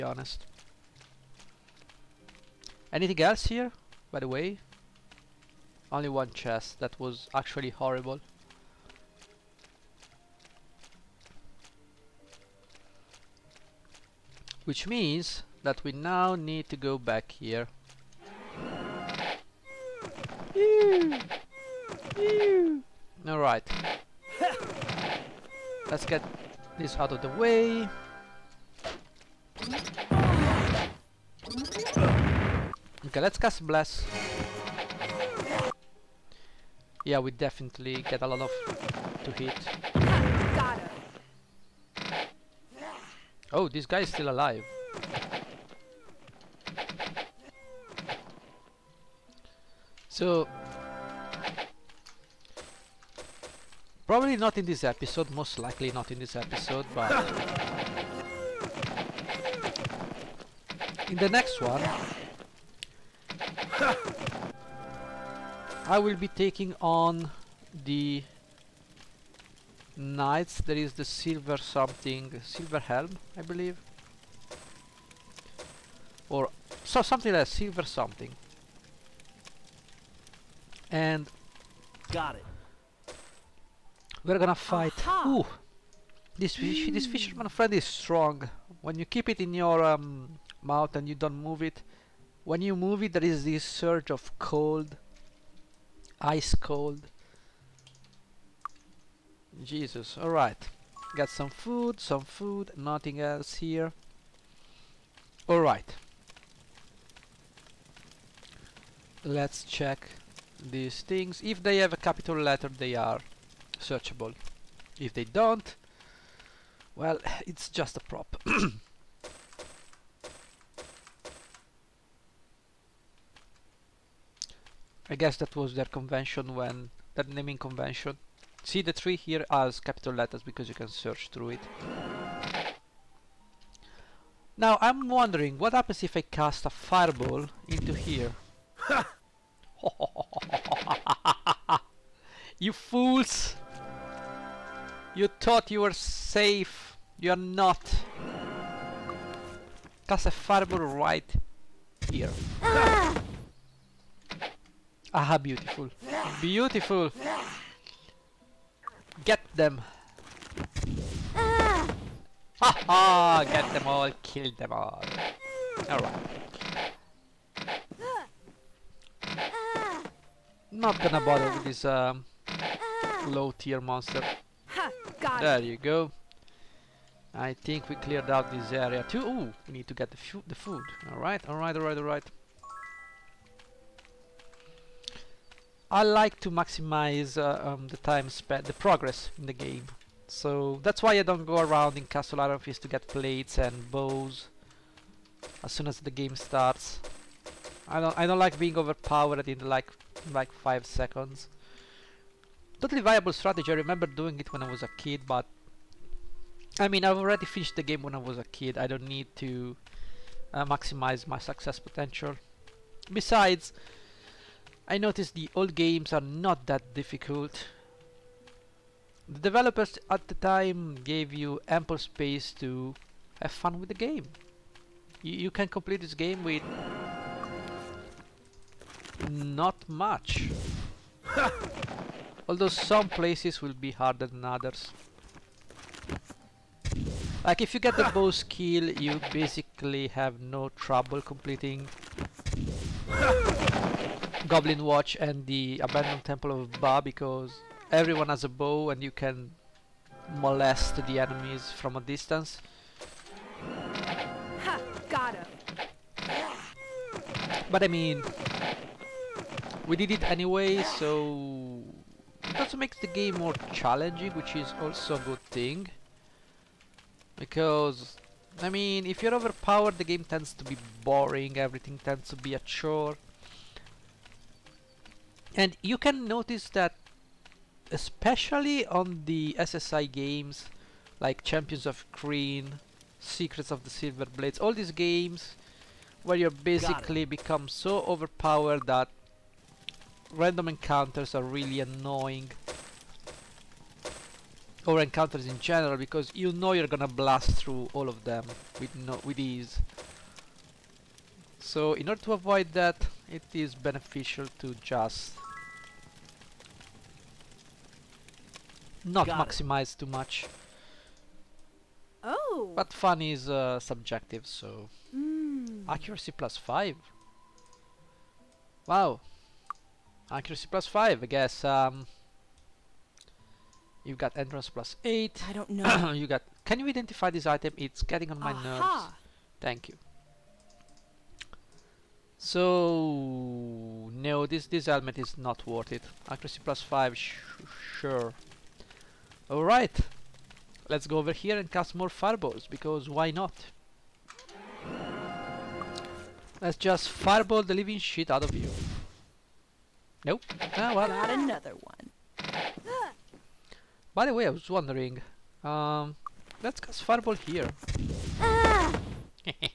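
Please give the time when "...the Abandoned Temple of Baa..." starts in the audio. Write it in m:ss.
4:05.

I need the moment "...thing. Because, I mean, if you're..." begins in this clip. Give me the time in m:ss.
4:25.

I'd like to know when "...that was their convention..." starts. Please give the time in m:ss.
2:05.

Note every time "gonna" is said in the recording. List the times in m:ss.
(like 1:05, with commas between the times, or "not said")
1:24, 2:50, 4:56.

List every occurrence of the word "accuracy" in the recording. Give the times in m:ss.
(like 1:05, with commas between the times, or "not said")
5:15, 5:20, 5:36.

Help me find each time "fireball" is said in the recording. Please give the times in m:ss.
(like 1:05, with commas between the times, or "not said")
2:16, 2:30, 5:42, 5:47, 5:57.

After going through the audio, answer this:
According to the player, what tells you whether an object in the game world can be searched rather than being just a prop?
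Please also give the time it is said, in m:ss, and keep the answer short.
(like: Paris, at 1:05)
A capital letter, at 1:51.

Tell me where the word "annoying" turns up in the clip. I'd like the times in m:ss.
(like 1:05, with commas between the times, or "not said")
4:51.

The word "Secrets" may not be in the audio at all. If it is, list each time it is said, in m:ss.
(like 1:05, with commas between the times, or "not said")
4:43.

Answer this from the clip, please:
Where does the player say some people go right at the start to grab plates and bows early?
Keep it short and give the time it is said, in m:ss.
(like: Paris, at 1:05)
Castle Fist, at 3:12.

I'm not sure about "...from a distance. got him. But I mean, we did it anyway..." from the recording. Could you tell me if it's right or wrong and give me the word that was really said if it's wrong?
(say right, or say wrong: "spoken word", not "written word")
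right.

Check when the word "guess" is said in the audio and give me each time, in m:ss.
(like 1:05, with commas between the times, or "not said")
2:05, 5:21.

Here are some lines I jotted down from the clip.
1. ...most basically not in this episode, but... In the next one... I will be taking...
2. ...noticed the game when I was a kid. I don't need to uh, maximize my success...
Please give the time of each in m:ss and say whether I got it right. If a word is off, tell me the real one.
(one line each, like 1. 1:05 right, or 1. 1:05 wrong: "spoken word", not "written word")
1. 0:55 wrong: "likely", not "basically"
2. 3:27 wrong: "finished", not "noticed".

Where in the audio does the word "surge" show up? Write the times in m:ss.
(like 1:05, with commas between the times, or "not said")
1:33.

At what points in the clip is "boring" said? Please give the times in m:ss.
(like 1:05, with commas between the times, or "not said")
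4:31.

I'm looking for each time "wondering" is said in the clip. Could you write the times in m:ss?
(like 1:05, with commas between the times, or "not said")
2:15, 5:54.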